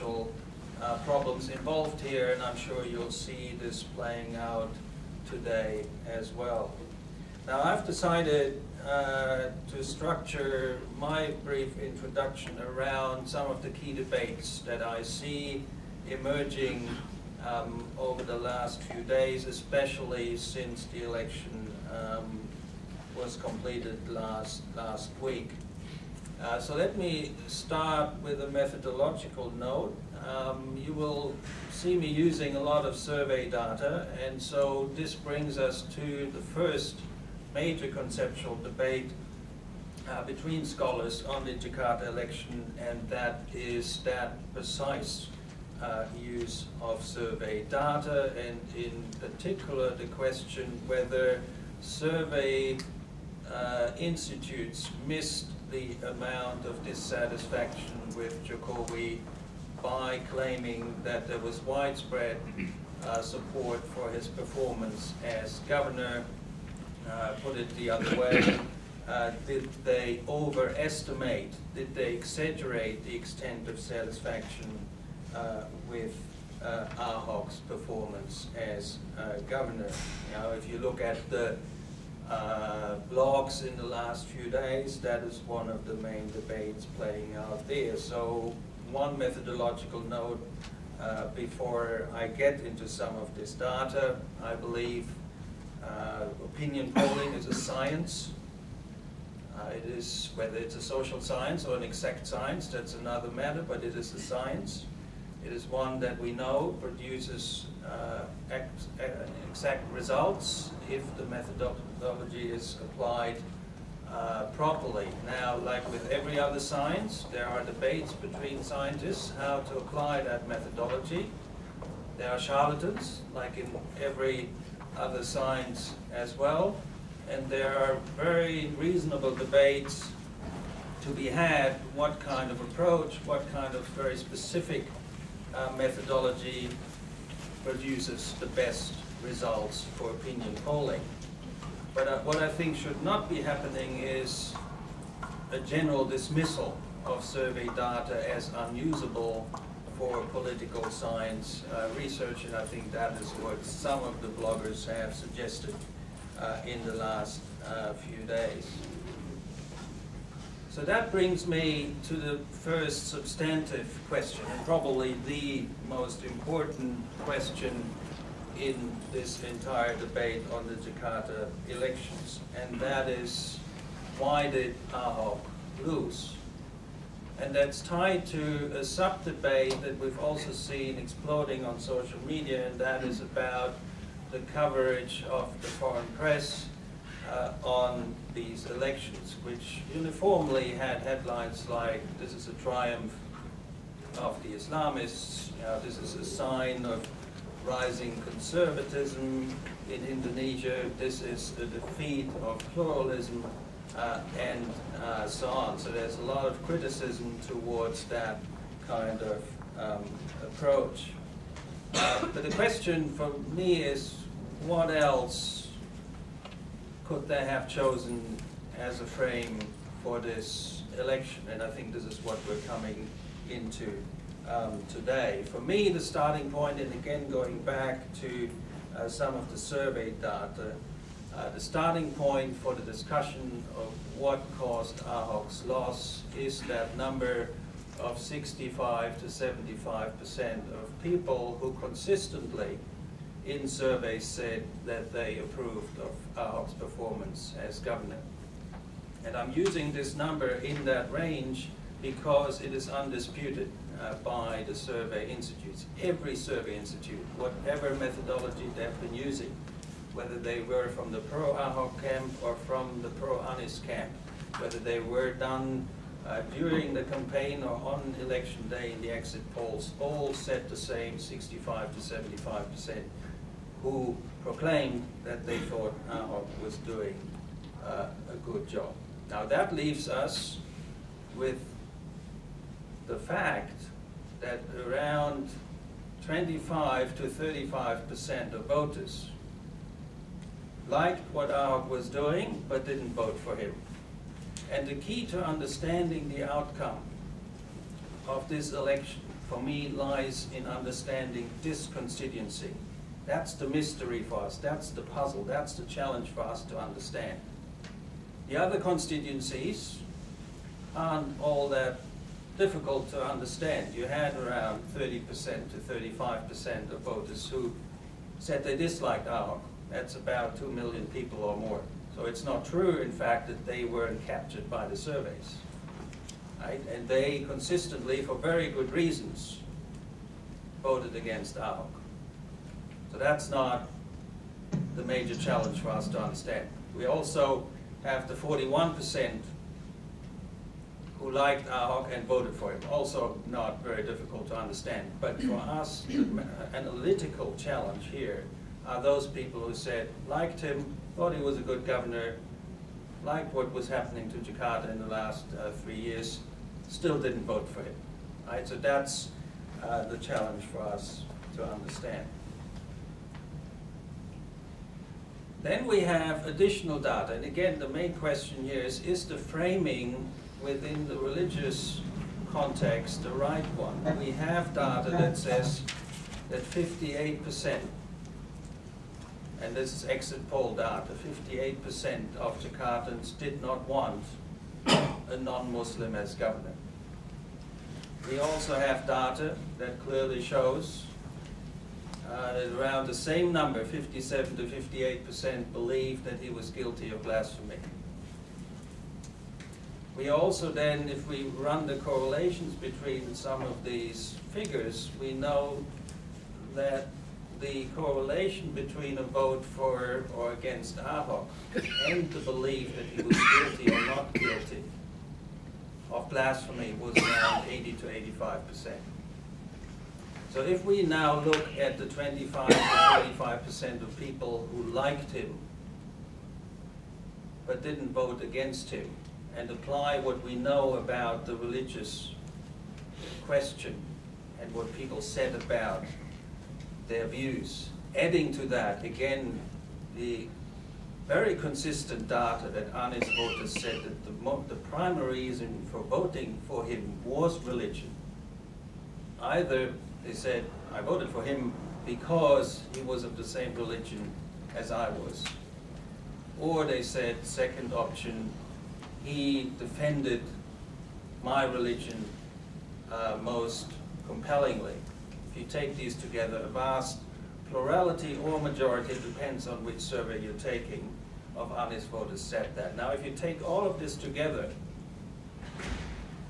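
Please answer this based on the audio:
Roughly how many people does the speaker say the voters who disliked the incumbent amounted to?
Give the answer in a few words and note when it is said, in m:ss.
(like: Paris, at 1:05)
2 million, at 5:20.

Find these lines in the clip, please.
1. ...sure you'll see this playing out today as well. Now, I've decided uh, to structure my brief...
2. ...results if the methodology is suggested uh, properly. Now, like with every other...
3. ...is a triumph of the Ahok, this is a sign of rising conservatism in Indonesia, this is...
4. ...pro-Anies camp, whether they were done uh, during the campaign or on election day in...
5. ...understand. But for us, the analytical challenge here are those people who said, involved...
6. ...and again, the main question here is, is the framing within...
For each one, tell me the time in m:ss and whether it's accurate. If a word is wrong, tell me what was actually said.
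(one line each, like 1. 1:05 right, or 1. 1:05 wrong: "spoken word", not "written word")
1. 0:02 right
2. 1:49 wrong: "applied", not "suggested"
3. 3:12 wrong: "Islamists", not "Ahok"
4. 4:23 right
5. 5:44 wrong: "liked", not "involved"
6. 6:07 right.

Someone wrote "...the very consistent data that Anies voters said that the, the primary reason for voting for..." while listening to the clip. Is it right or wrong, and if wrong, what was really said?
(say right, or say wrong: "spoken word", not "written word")
right.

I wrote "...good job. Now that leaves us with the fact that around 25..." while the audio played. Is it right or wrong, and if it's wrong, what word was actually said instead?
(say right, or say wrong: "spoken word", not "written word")
right.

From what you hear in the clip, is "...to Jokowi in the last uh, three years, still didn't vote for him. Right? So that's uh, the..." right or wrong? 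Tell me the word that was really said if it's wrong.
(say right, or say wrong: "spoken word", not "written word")
wrong: "Jakarta", not "Jokowi".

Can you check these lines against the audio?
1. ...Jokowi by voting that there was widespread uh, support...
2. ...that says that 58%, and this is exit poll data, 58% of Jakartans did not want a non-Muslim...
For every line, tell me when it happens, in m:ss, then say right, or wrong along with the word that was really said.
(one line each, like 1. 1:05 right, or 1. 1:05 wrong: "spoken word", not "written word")
1. 0:58 wrong: "claiming", not "voting"
2. 6:15 right.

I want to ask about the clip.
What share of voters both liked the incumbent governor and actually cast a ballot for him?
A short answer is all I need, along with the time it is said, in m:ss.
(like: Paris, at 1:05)
41%, at 5:38.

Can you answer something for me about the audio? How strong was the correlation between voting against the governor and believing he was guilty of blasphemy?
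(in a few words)
80 to 85 percent.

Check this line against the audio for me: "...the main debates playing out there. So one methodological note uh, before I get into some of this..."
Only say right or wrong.
right.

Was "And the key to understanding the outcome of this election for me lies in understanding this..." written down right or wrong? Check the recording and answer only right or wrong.
right.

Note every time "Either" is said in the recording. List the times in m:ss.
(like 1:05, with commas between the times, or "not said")
7:29.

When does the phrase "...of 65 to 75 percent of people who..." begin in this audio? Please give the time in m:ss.
3:57.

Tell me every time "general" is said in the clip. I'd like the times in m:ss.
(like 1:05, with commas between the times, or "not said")
2:25.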